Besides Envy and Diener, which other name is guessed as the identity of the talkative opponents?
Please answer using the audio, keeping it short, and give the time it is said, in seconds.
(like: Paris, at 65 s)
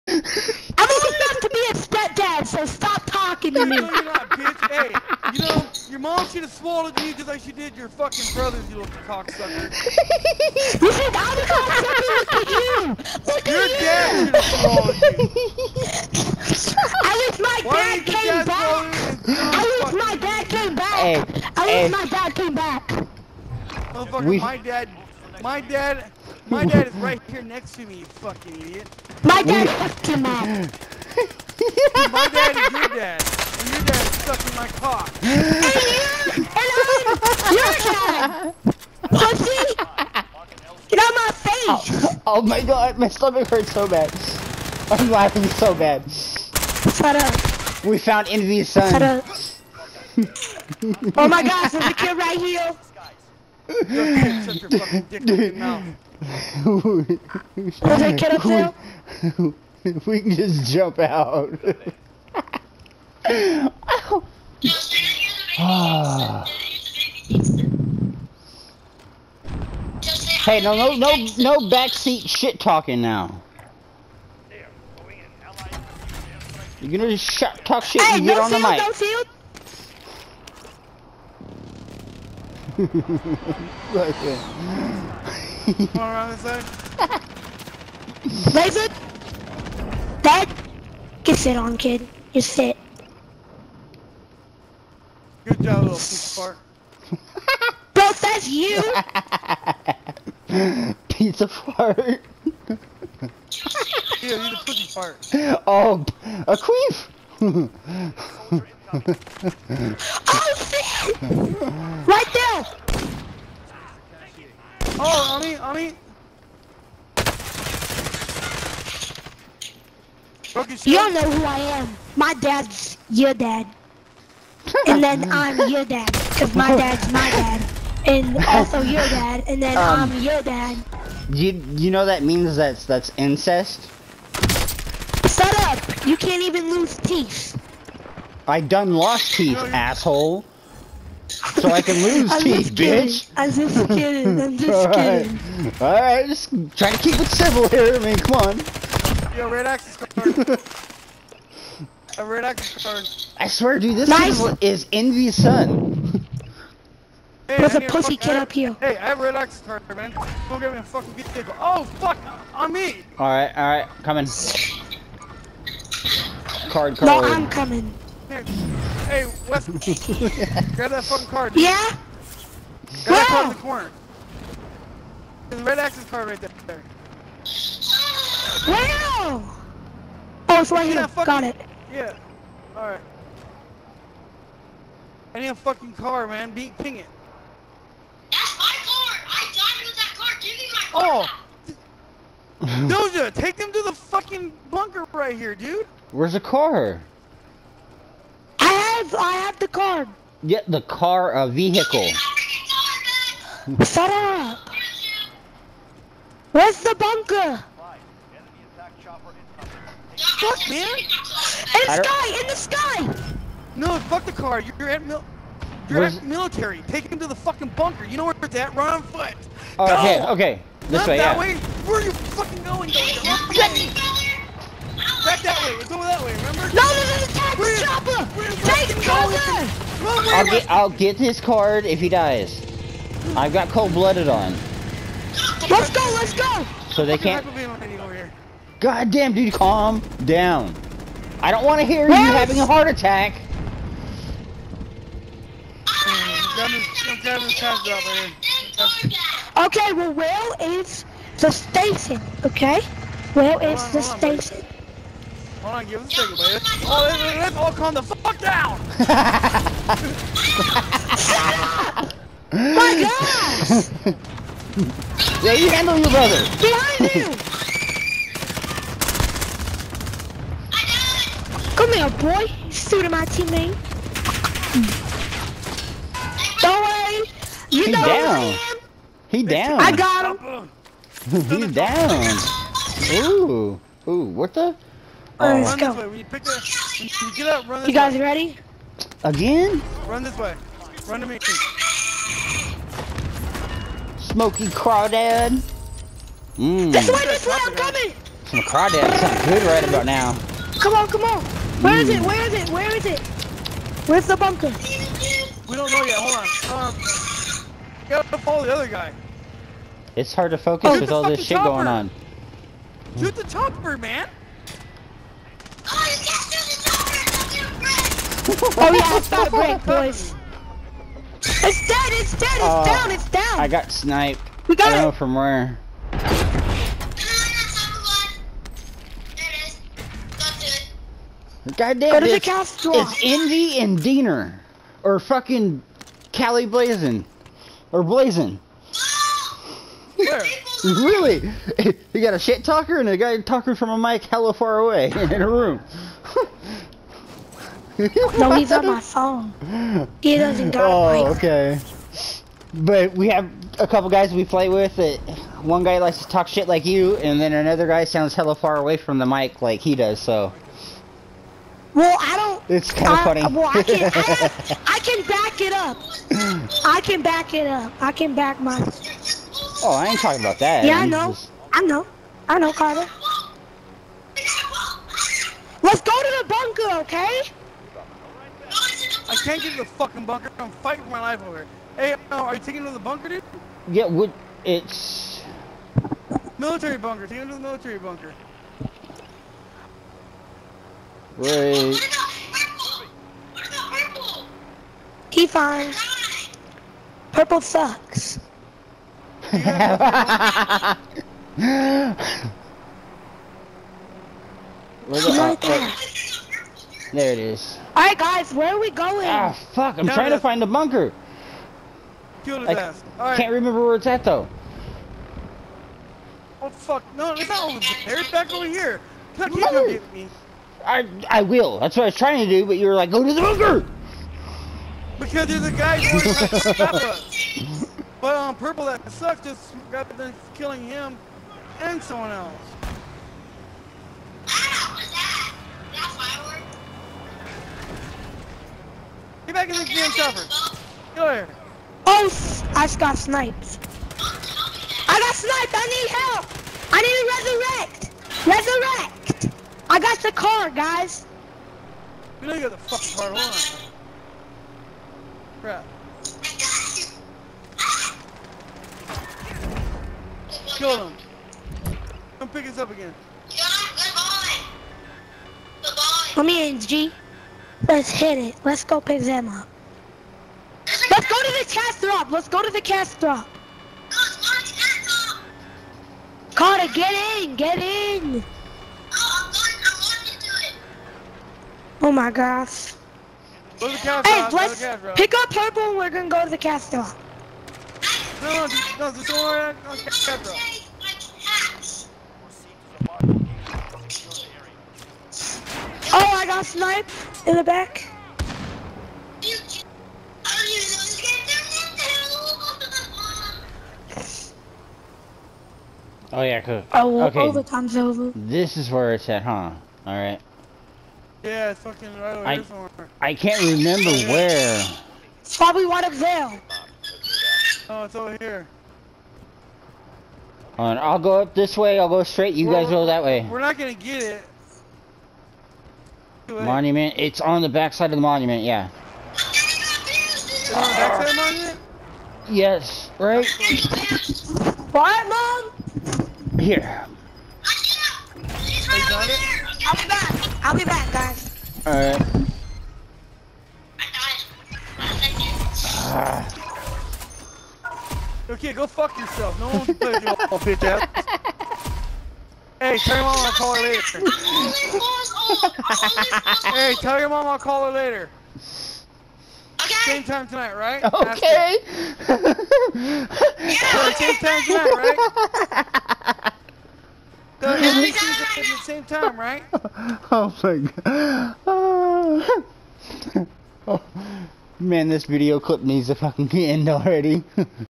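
Cali Blazin, at 336 s.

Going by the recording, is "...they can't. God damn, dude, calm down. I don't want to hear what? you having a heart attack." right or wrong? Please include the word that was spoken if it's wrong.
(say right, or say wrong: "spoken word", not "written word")
right.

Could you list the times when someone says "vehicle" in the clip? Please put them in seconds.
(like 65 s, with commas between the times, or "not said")
161 s, 201 s.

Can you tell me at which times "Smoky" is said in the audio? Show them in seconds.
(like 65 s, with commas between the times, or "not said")
294 s.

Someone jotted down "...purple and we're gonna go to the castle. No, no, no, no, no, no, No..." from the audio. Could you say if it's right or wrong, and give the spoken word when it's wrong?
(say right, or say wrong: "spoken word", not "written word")
right.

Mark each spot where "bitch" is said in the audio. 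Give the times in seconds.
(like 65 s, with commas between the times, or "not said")
4 s, 142 s, 550 s.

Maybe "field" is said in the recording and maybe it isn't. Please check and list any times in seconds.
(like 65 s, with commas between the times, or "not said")
78 s, 83 s.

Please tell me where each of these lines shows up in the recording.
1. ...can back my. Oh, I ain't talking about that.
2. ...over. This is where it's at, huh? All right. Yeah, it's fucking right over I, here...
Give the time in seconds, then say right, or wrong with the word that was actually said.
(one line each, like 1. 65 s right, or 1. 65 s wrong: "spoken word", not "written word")
1. 368 s right
2. 507 s right.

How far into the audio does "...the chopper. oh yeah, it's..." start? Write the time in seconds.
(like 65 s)
316 s.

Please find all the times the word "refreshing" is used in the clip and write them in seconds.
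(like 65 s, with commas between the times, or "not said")
not said.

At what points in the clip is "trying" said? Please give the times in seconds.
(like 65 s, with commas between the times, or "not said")
410 s, 422 s.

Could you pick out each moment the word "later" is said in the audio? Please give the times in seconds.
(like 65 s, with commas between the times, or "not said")
553 s, 557 s.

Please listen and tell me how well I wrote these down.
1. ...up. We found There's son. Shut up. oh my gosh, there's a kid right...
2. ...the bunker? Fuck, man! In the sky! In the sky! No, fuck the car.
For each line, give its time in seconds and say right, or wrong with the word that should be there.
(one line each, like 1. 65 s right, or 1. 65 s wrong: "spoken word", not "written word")
1. 47 s wrong: "Envy", not "There"
2. 206 s right.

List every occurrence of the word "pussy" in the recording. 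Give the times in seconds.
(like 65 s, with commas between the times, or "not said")
39 s, 104 s, 157 s.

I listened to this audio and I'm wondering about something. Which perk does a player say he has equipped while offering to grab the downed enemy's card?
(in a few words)
Cold blooded.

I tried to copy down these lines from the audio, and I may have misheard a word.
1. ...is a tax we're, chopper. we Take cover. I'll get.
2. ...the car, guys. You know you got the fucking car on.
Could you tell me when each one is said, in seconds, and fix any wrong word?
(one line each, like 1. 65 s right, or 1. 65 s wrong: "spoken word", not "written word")
1. 227 s right
2. 450 s right.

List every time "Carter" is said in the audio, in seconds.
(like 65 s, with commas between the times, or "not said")
372 s, 476 s.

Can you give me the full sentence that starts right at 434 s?
that, is Get back in the game, Chopper.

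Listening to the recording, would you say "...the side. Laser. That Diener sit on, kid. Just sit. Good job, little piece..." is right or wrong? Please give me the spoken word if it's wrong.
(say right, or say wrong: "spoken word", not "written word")
wrong: "Get", not "Diener".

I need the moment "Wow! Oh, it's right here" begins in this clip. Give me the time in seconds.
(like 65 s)
178 s.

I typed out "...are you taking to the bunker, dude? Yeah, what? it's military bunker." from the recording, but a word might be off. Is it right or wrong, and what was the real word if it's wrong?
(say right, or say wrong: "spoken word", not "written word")
right.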